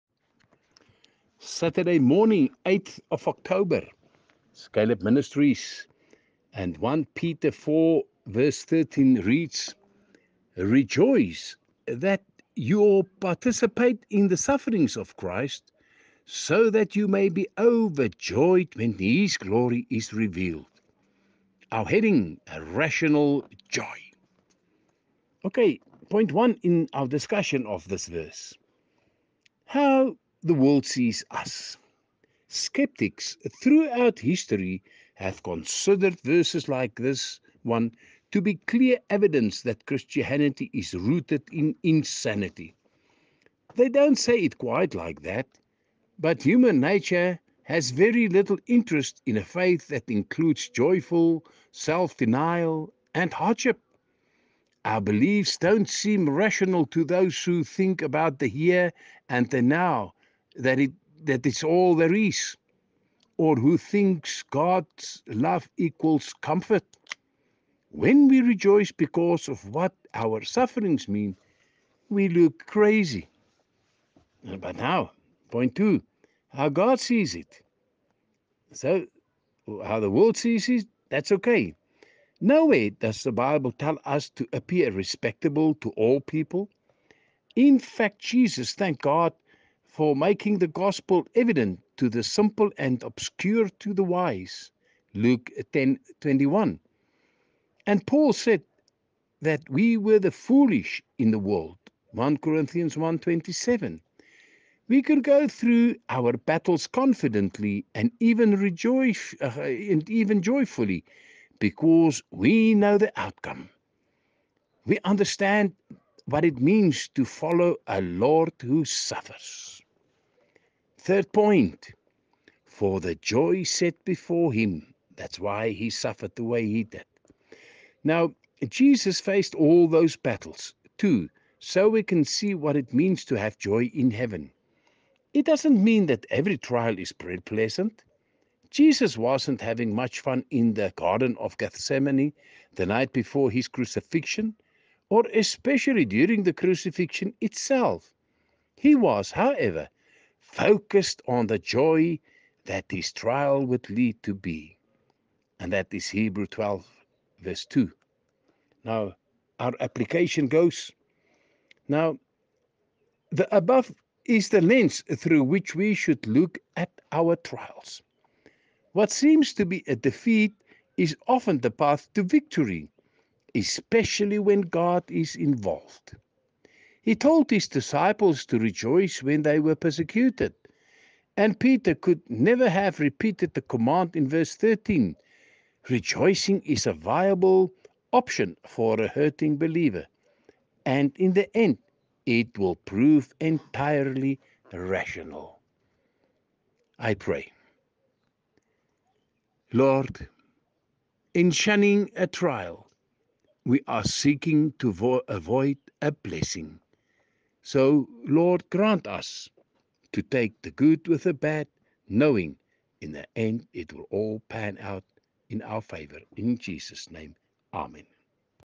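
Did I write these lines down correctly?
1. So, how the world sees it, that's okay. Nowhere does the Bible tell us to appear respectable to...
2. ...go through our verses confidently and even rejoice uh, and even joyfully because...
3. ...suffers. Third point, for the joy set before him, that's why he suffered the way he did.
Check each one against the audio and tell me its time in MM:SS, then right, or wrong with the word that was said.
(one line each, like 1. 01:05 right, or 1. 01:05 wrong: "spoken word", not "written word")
1. 01:18 right
2. 01:45 wrong: "battles", not "verses"
3. 01:58 right.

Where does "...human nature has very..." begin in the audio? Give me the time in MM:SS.
00:46.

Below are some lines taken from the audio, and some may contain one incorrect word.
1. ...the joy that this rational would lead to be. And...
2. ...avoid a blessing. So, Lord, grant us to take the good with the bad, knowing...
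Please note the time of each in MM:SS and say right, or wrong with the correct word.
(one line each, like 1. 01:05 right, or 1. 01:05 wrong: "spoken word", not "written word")
1. 02:31 wrong: "trial", not "rational"
2. 03:25 right.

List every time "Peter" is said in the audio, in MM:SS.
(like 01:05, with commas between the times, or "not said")
00:07, 03:01.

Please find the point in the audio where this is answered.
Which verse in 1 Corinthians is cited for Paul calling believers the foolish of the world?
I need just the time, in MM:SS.
01:42.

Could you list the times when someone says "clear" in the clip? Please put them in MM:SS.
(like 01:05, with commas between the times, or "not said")
00:38.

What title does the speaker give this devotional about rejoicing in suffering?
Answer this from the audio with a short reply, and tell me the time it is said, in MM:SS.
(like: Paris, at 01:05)
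Rational joy, at 00:22.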